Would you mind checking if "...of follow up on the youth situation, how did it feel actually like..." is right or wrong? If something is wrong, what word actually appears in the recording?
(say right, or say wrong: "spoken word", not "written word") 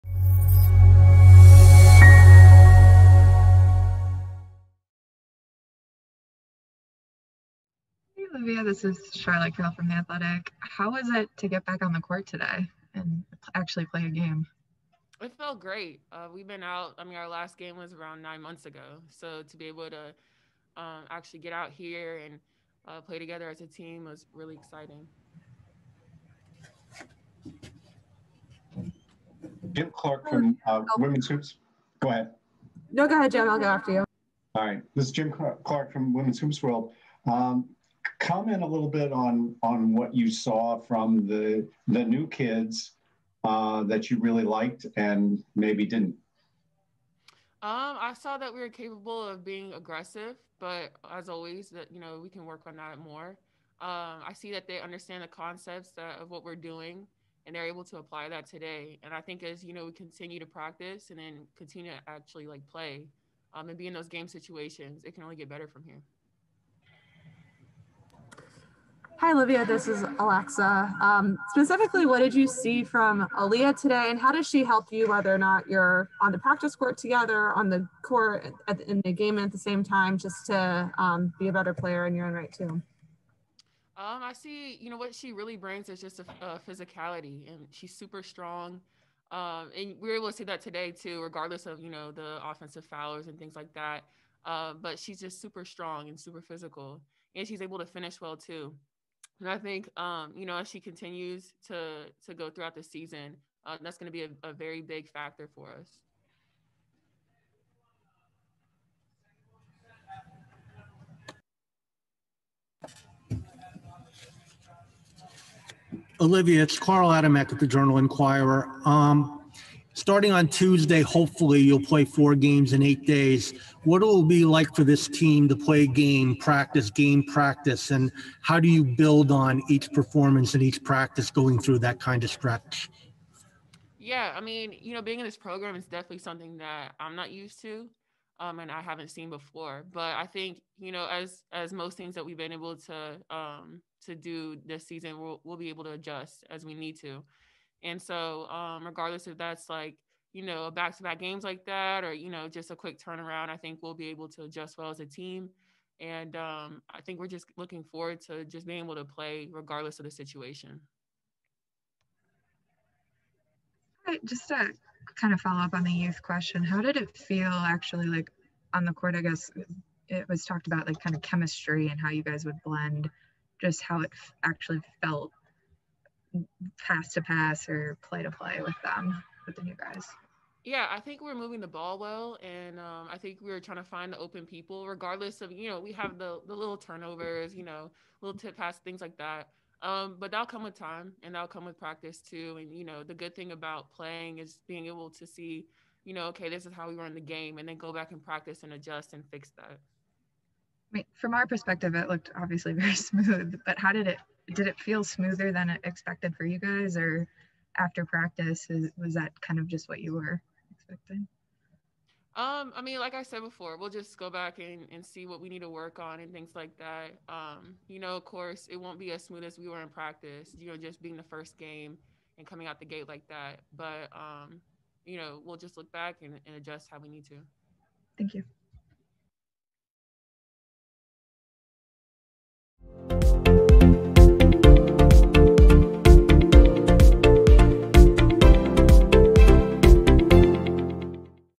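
wrong: "question", not "situation".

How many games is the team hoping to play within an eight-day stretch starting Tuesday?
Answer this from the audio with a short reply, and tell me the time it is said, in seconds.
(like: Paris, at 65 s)
4, at 122 s.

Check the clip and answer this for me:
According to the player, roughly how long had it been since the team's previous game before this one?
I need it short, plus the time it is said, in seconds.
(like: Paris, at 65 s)
9 months, at 18 s.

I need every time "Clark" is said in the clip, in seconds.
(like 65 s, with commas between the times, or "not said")
29 s, 35 s.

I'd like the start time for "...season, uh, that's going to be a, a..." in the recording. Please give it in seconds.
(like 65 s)
102 s.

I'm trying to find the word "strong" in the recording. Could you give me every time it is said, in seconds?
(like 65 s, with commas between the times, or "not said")
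88 s, 95 s.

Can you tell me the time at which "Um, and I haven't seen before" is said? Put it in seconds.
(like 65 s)
138 s.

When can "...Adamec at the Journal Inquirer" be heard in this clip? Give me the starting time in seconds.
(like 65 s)
117 s.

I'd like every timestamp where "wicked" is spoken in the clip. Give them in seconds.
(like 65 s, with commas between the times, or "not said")
not said.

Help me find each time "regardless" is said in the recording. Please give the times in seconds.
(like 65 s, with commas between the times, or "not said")
91 s, 148 s, 159 s, 184 s.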